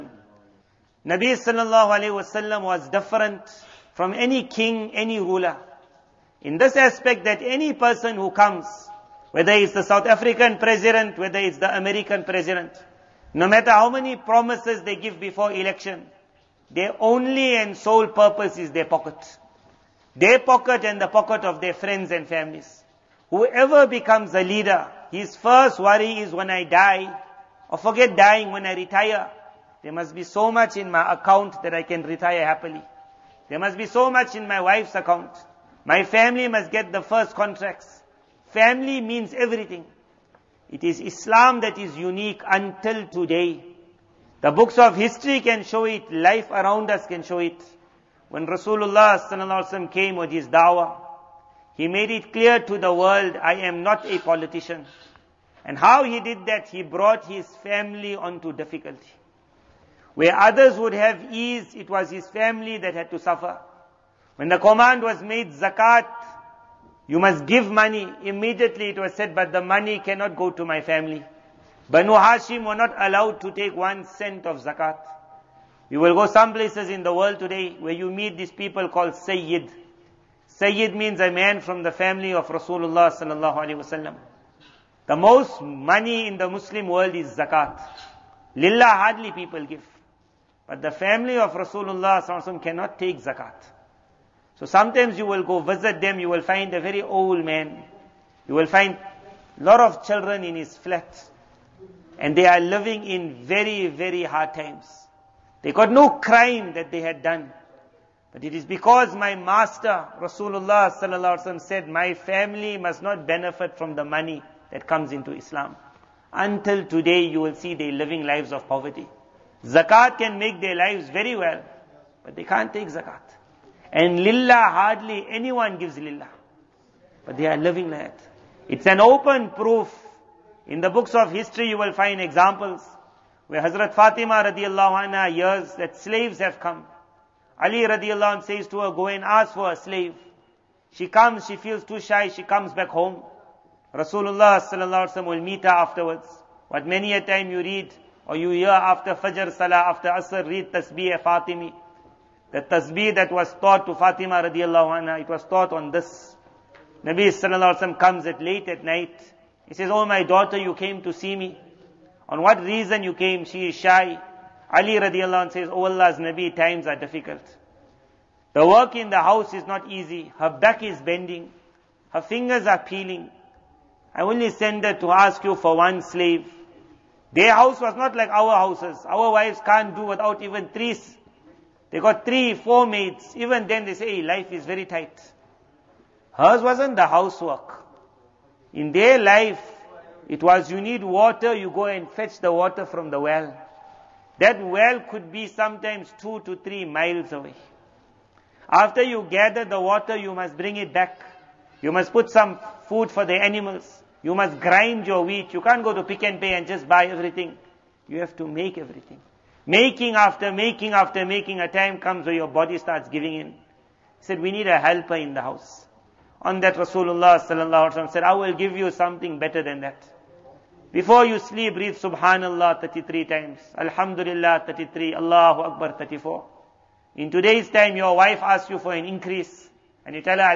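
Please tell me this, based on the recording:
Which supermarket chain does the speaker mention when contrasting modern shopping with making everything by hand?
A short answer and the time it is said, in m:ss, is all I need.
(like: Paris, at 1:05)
Pick n Pay, at 3:26.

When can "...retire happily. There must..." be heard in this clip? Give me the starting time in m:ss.
0:32.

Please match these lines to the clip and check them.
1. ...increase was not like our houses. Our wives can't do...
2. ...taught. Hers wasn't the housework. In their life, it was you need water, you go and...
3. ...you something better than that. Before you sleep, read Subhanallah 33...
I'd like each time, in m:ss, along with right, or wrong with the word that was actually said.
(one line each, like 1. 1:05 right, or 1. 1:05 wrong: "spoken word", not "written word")
1. 2:57 wrong: "house", not "increase"
2. 3:04 wrong: "tight", not "taught"
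3. 3:38 right.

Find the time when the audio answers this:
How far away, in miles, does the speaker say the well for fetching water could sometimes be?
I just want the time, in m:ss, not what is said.
3:16.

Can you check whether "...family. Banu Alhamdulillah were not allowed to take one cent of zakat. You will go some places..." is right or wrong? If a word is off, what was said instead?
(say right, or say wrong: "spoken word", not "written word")
wrong: "Hashim", not "Alhamdulillah".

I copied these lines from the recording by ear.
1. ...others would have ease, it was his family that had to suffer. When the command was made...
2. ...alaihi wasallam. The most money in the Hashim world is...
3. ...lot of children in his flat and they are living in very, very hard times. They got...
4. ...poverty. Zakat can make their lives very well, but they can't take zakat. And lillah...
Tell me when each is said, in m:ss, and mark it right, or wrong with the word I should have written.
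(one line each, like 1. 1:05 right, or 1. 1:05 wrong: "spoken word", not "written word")
1. 1:00 right
2. 1:23 wrong: "Muslim", not "Hashim"
3. 1:39 right
4. 1:58 right.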